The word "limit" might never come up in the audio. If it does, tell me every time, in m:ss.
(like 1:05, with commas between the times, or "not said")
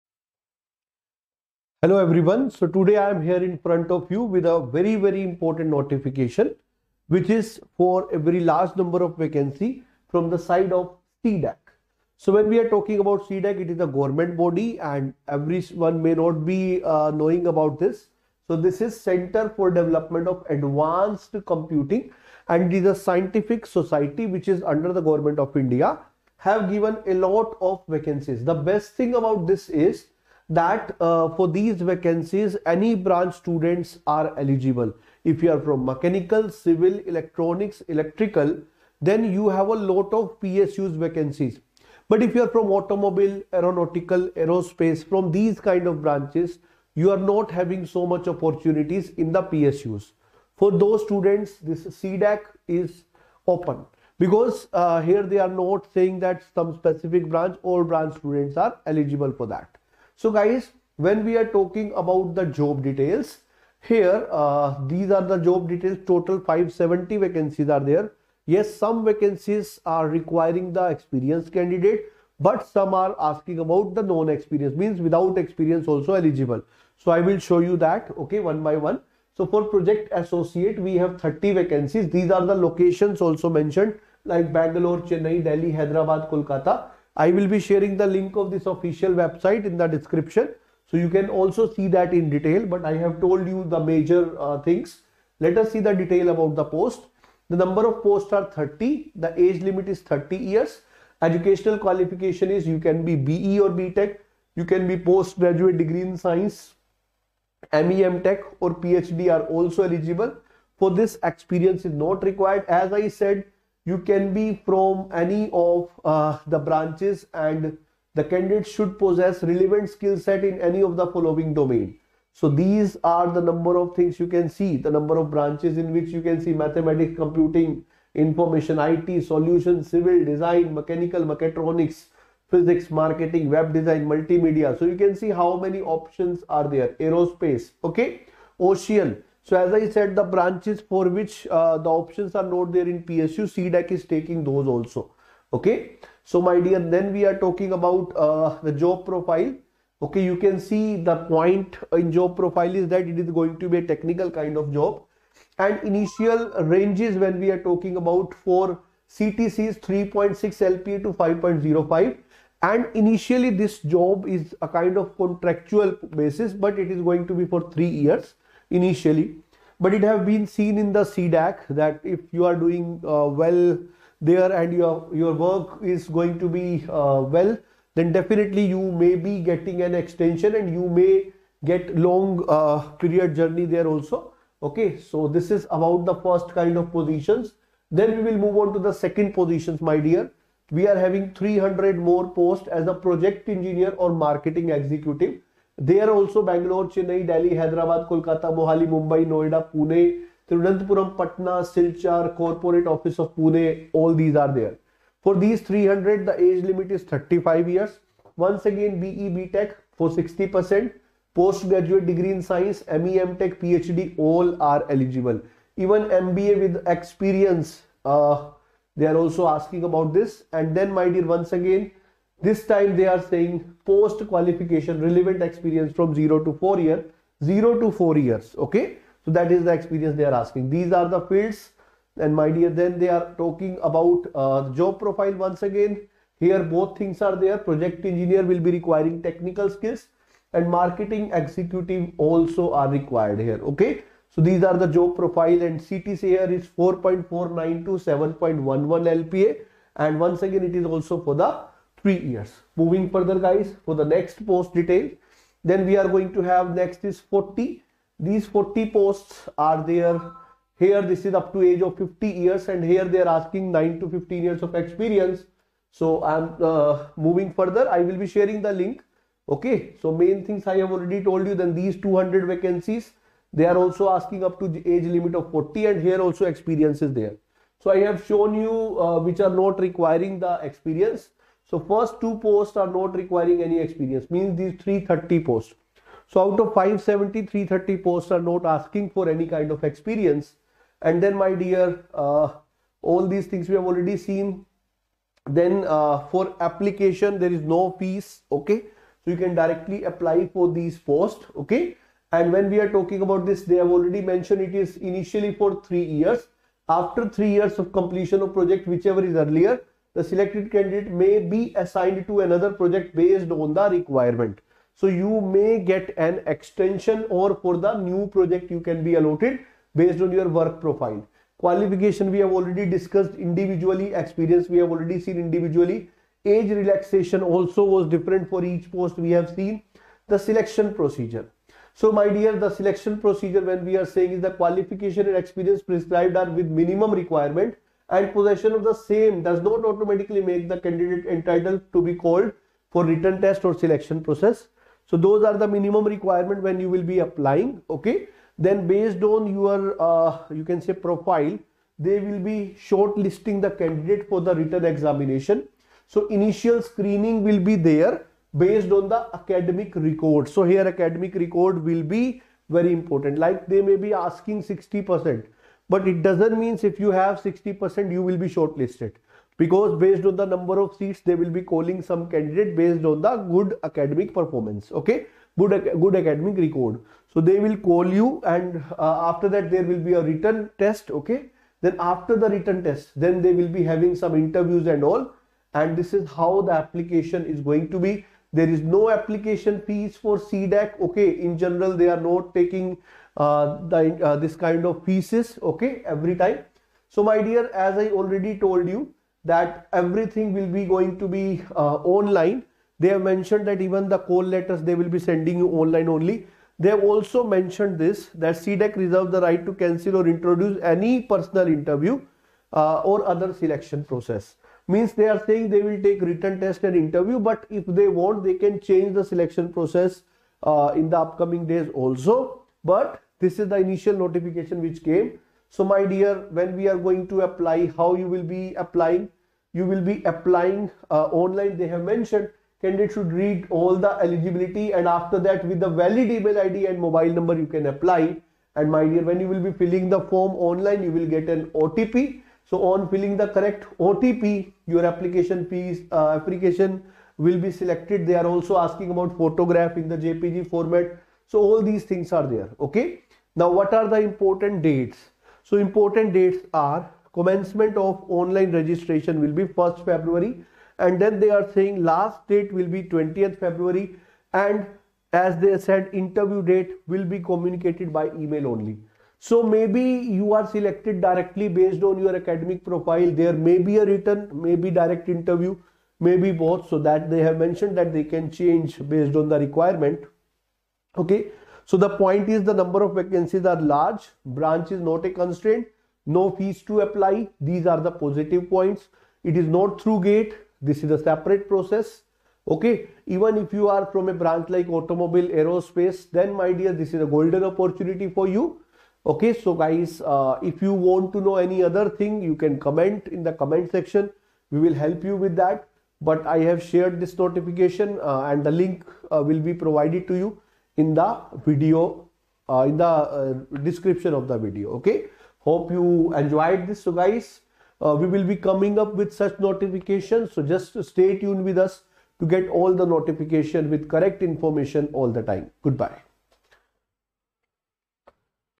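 1:39, 3:26, 4:35.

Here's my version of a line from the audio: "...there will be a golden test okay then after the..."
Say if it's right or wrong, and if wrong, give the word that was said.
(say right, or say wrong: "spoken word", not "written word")
wrong: "written", not "golden".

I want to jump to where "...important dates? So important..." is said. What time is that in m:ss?
7:34.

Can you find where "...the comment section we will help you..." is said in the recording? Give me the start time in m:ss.
8:23.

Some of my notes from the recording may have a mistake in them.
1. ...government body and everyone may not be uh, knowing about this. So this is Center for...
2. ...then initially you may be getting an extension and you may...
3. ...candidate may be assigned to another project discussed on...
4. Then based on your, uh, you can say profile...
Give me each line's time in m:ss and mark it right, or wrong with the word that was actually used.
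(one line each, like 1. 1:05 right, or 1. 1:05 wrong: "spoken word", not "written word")
1. 0:13 right
2. 2:57 wrong: "definitely", not "initially"
3. 5:10 wrong: "based", not "discussed"
4. 5:48 right.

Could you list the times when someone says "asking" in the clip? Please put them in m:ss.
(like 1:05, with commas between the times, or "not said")
1:13, 3:39, 3:50, 4:23, 4:34, 4:48, 6:04, 7:28.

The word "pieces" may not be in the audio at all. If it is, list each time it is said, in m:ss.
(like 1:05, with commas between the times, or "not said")
6:35, 7:25.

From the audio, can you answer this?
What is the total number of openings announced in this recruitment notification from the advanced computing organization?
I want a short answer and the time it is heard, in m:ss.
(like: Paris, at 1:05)
570, at 1:06.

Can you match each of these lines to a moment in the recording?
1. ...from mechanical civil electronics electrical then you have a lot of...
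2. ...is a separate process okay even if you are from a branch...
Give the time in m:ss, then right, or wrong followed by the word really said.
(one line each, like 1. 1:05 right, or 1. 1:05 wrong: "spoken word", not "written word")
1. 0:35 right
2. 8:11 right.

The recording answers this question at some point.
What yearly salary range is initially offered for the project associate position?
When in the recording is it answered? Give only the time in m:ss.
2:39.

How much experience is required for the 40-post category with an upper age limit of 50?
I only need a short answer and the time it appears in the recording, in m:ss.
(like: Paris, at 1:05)
9 to 15 years, at 4:23.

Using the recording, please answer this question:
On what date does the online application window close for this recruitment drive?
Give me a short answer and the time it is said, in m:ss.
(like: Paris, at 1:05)
20th February, at 7:43.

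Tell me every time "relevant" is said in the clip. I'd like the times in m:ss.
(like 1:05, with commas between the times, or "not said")
1:59, 3:44.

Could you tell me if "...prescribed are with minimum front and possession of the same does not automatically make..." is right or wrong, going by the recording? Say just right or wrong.
wrong.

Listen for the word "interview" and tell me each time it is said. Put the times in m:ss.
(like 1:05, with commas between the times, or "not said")
6:24, 6:51, 6:56, 7:46, 7:55.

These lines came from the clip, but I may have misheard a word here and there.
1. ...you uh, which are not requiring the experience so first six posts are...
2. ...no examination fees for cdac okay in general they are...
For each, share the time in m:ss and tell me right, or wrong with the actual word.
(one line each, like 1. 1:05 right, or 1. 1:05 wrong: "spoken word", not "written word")
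1. 4:38 wrong: "two", not "six"
2. 6:28 wrong: "application", not "examination".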